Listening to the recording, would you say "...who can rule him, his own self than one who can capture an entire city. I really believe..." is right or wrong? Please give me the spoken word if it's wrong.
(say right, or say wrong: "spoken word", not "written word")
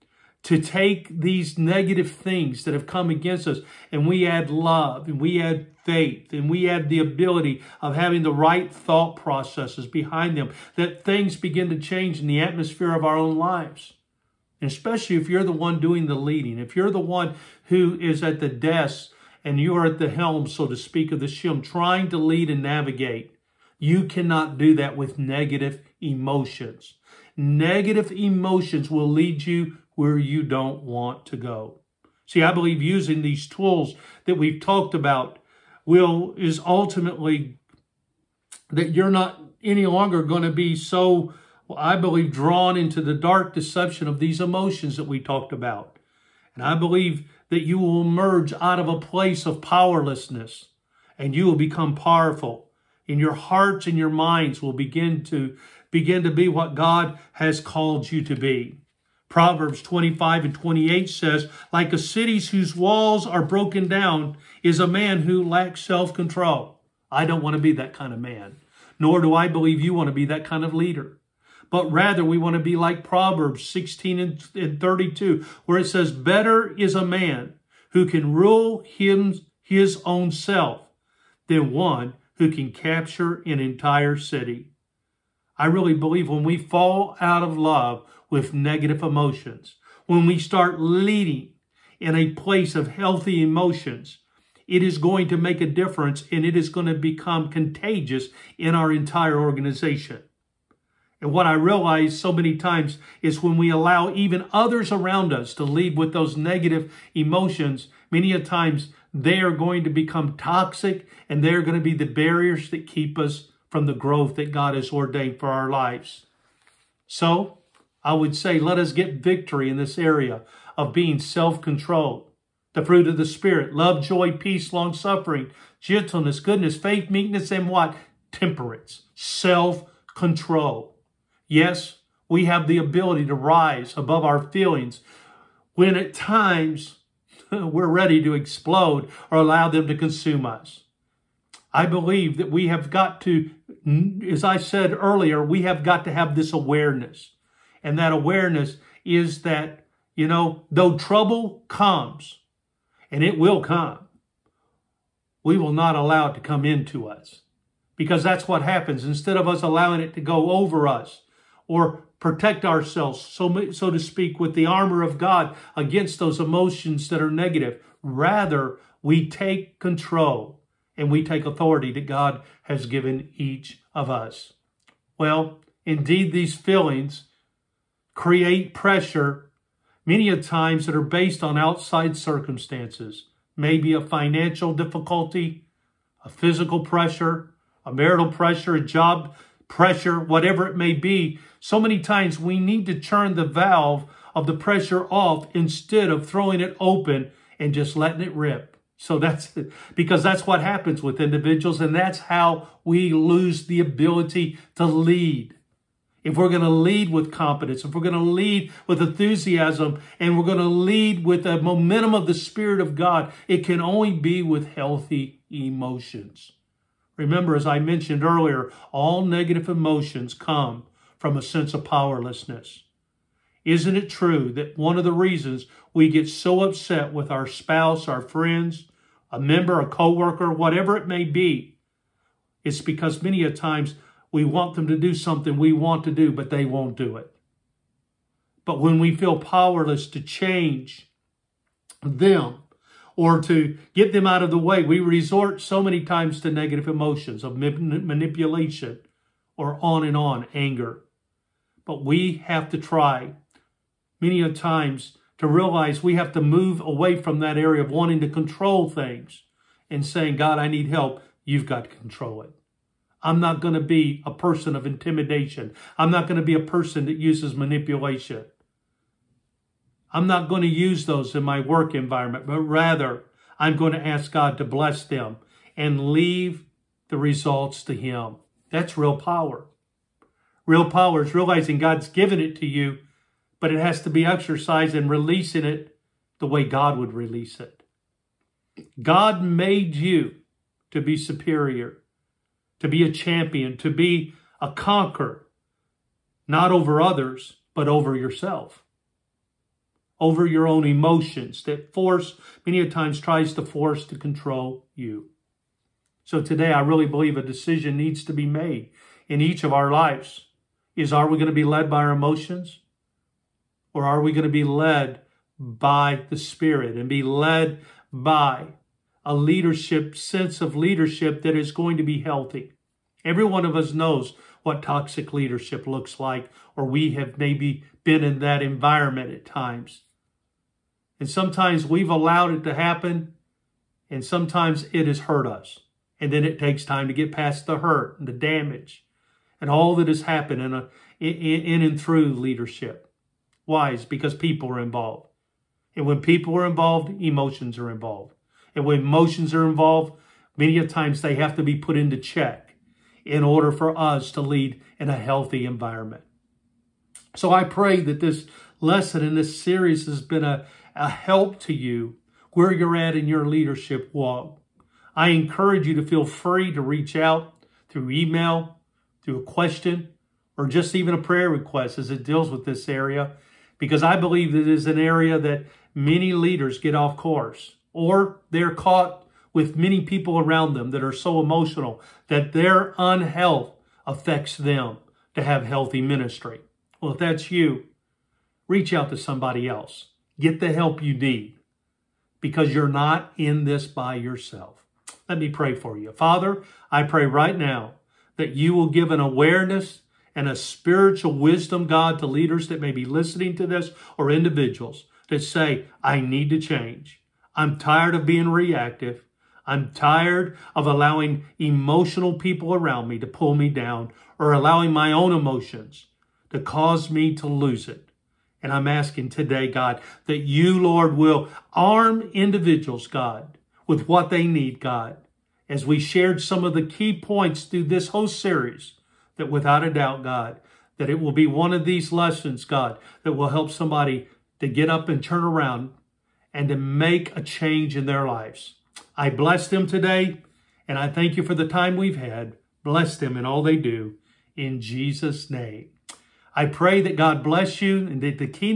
right.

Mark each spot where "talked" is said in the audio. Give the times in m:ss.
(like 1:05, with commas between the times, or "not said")
0:34, 0:45.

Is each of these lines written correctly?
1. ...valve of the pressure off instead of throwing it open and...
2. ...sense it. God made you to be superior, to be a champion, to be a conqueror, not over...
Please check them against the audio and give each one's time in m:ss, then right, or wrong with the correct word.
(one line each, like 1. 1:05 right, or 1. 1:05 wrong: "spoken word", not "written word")
1. 3:13 right
2. 4:47 wrong: "release", not "sense".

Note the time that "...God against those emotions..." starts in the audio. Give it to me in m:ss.
2:45.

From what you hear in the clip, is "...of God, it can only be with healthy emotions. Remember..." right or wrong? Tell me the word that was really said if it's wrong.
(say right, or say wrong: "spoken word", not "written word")
right.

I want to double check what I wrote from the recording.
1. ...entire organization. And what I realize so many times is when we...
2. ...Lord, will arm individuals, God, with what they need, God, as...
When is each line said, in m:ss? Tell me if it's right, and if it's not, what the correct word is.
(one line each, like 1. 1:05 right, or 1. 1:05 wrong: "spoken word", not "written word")
1. 1:38 right
2. 7:00 right.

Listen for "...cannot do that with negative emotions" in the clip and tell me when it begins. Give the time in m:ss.
0:24.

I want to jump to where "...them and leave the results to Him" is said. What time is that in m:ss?
4:35.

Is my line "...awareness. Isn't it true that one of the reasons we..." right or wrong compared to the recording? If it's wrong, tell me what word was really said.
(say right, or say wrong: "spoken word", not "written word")
wrong: "powerlessness", not "awareness".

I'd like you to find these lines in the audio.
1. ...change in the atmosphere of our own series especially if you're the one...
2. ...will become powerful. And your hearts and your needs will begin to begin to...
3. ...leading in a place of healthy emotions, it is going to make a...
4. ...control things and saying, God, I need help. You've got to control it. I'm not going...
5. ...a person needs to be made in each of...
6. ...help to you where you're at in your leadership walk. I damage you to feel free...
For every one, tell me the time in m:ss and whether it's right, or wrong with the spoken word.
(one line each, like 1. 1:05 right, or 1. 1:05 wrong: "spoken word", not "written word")
1. 0:11 wrong: "lives", not "series"
2. 0:51 wrong: "minds", not "needs"
3. 1:30 right
4. 4:18 right
5. 5:07 wrong: "decision", not "person"
6. 6:01 wrong: "encourage", not "damage".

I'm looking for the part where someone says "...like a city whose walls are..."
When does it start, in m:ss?
1:01.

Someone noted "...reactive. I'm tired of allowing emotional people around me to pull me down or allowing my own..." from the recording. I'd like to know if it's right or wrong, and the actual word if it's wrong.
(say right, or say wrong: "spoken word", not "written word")
right.